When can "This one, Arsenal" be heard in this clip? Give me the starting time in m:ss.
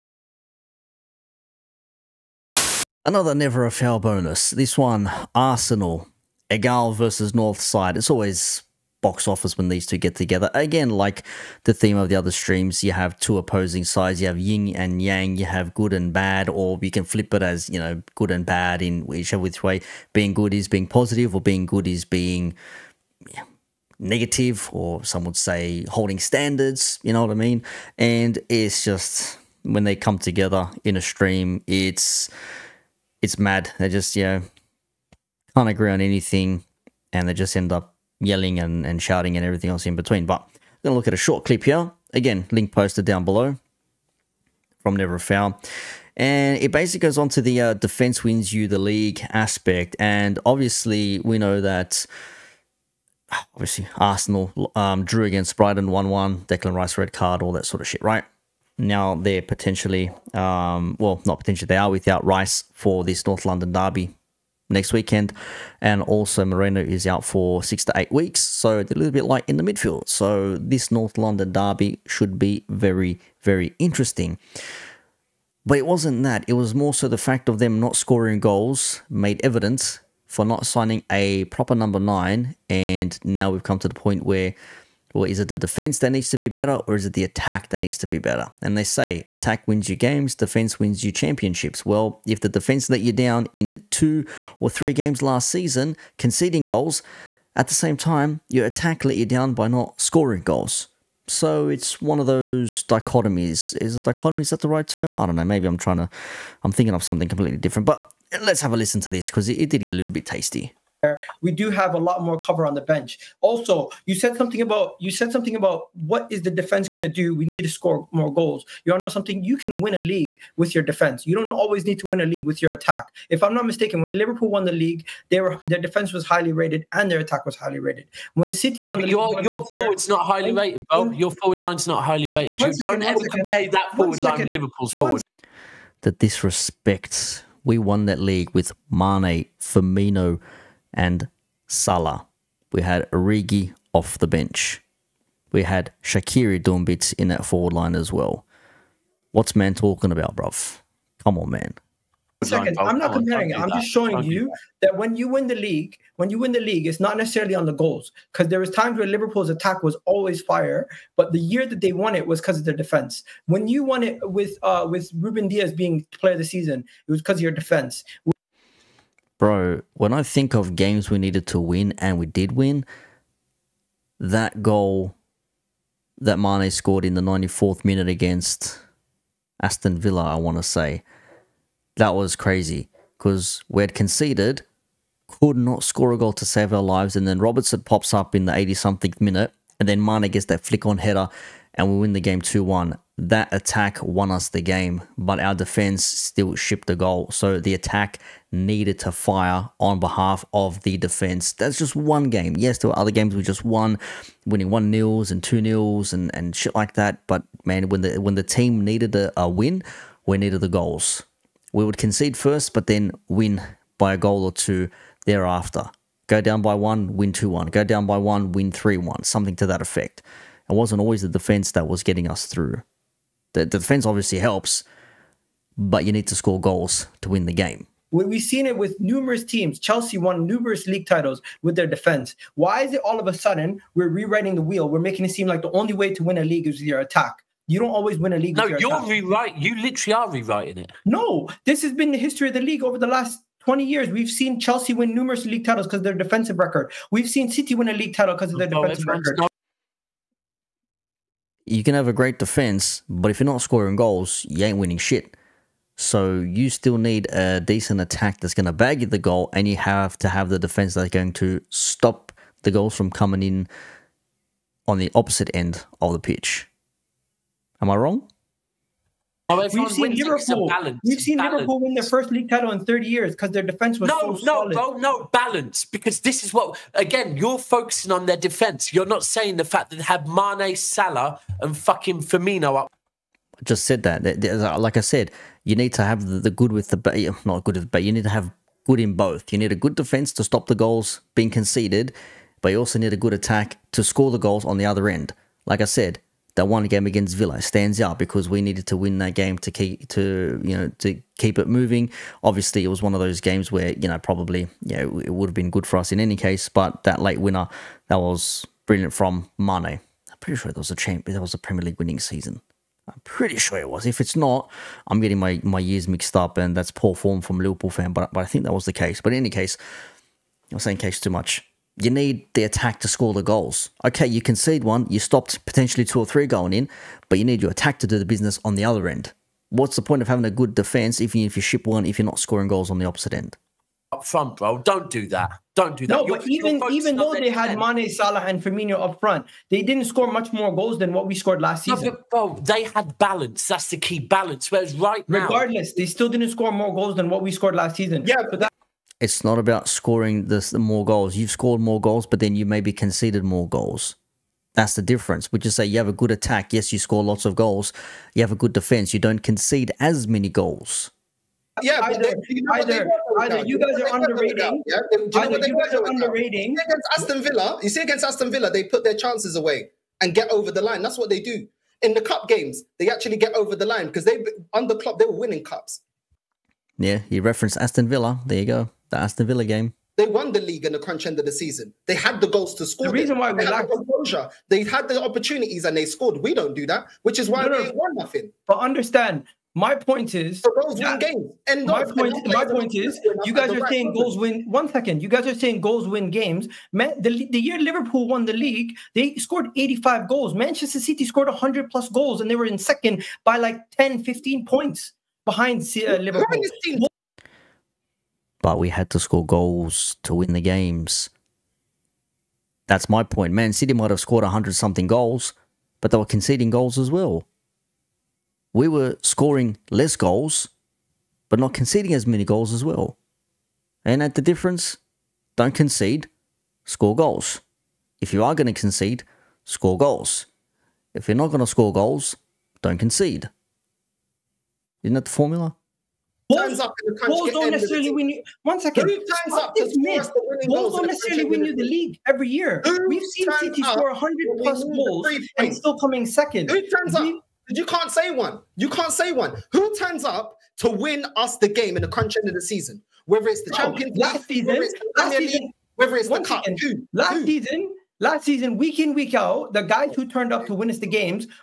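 0:04.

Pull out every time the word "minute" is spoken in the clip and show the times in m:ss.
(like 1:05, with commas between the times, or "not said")
2:57, 3:09.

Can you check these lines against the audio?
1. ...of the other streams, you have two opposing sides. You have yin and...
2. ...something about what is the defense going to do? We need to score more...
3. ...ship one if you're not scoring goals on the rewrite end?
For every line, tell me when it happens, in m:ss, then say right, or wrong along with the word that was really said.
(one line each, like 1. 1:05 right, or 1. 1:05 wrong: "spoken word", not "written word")
1. 0:11 right
2. 1:55 right
3. 5:31 wrong: "opposite", not "rewrite".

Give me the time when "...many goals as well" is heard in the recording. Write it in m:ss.
7:02.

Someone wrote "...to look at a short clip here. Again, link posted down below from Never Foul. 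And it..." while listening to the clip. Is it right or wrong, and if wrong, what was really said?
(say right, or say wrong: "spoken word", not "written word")
right.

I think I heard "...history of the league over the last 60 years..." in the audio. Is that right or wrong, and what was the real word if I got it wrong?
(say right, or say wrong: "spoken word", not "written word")
wrong: "20", not "60".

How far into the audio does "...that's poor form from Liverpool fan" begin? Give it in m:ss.
5:16.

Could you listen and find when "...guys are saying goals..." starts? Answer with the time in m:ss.
6:35.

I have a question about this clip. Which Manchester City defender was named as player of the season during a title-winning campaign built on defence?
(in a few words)
Ruben Dias.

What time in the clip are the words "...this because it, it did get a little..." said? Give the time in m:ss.
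1:49.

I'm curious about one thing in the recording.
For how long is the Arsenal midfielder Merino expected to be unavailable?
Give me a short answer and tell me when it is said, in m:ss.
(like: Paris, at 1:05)
six to eight weeks, at 1:07.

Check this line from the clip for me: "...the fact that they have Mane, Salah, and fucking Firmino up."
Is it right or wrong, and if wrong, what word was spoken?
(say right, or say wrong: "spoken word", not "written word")
right.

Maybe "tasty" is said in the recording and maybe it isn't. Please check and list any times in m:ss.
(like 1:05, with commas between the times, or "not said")
1:50.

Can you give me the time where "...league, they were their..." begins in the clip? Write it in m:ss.
2:04.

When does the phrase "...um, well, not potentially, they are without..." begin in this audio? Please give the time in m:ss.
1:00.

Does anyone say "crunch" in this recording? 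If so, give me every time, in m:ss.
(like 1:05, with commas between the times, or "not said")
6:20, 7:32.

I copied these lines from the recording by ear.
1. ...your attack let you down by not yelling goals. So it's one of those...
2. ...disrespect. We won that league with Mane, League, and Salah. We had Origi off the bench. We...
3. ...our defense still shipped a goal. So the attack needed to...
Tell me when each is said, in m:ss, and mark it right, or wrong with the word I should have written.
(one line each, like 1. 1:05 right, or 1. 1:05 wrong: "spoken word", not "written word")
1. 1:38 wrong: "scoring", not "yelling"
2. 2:16 wrong: "Firmino", not "League"
3. 3:15 right.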